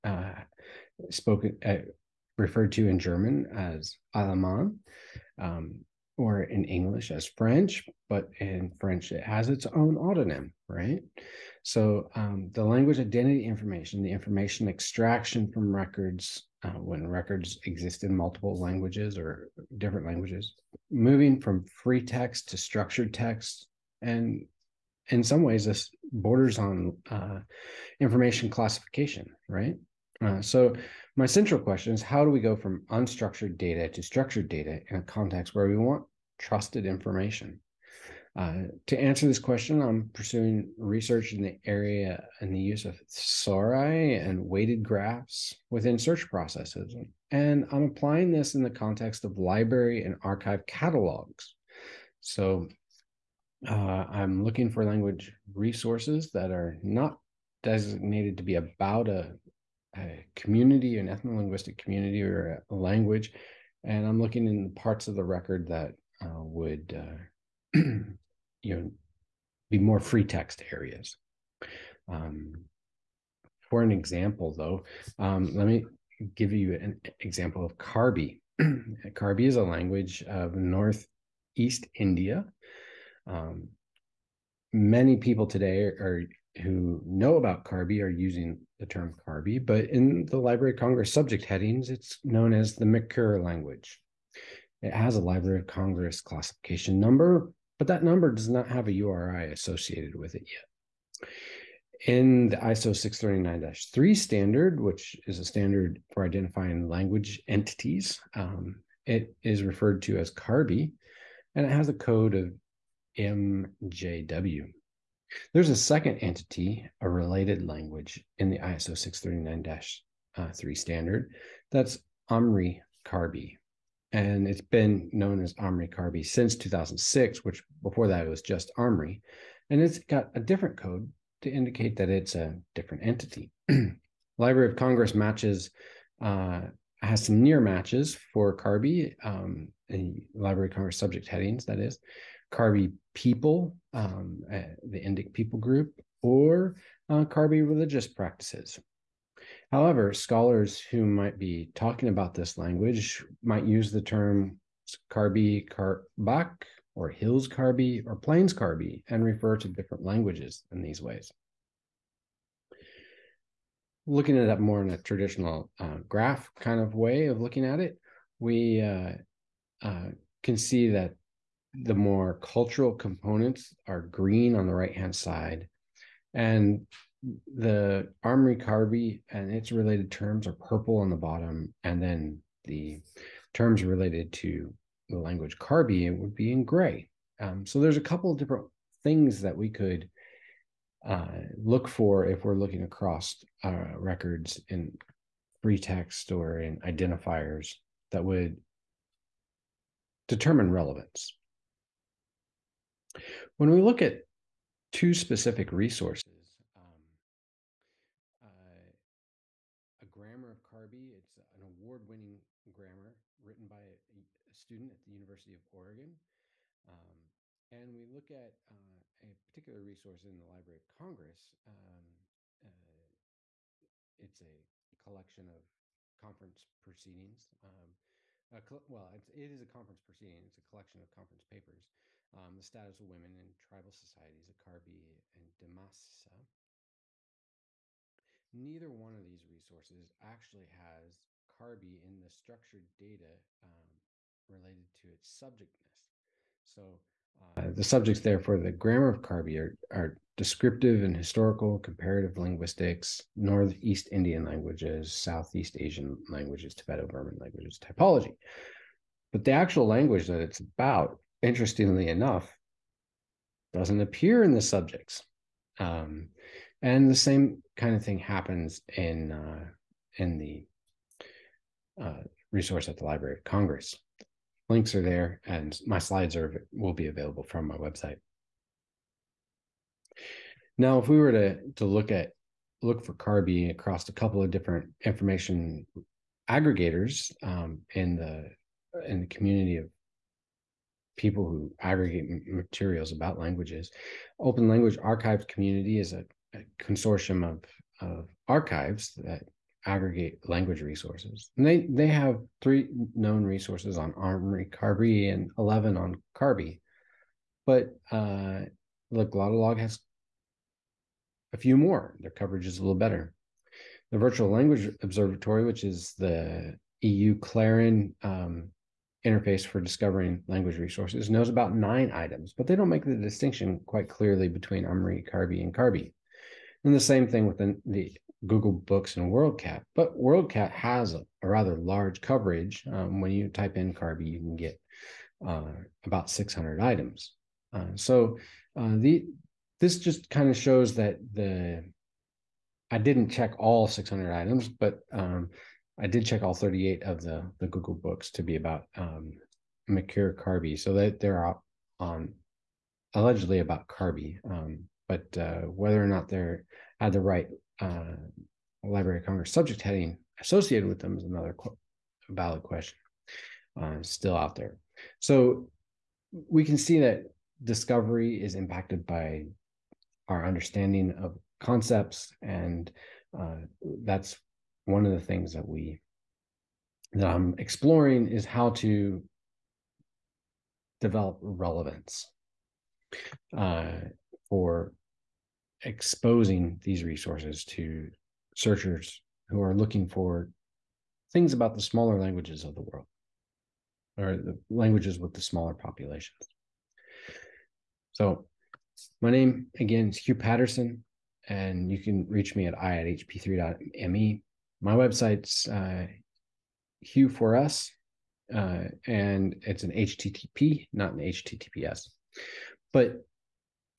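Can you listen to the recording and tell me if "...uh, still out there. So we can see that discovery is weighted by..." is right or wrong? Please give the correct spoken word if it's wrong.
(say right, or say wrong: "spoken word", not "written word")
wrong: "impacted", not "weighted".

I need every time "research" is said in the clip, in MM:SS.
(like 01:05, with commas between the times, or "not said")
00:40.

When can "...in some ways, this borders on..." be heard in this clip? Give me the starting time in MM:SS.
00:25.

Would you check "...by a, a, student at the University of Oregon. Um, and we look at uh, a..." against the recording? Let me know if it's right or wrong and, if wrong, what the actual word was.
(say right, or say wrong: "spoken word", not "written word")
right.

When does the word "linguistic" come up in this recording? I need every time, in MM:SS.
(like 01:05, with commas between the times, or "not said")
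01:01, 04:12.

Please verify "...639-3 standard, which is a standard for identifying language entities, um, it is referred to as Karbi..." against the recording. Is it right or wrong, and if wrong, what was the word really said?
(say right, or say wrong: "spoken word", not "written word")
right.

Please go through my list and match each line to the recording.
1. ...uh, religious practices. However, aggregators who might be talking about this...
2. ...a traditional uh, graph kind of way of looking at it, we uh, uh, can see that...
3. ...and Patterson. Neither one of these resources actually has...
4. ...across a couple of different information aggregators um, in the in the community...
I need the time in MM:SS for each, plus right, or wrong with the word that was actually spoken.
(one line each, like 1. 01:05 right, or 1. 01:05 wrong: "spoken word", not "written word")
1. 02:27 wrong: "scholars", not "aggregators"
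2. 02:44 right
3. 03:55 wrong: "Dimasa", not "Patterson"
4. 04:43 right.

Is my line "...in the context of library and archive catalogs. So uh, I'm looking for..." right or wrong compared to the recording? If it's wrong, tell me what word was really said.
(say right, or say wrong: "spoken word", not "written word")
right.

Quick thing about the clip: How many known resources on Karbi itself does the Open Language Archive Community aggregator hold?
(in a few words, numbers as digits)
11.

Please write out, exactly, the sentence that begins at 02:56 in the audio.
And the Amri Karbi and its related terms are purple on the bottom.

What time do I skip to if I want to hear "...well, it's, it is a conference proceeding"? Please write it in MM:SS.
03:48.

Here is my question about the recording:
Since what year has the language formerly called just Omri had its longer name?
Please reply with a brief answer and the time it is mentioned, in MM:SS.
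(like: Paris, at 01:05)
2006, at 02:06.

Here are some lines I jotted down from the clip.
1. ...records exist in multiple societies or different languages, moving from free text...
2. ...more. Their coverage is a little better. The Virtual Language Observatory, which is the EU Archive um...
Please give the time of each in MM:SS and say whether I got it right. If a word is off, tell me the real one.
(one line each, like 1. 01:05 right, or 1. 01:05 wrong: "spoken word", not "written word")
1. 00:17 wrong: "languages", not "societies"
2. 05:11 wrong: "Clarin", not "Archive".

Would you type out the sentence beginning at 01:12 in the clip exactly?
Um, for an example, though, um, let me give you an example of Karbi.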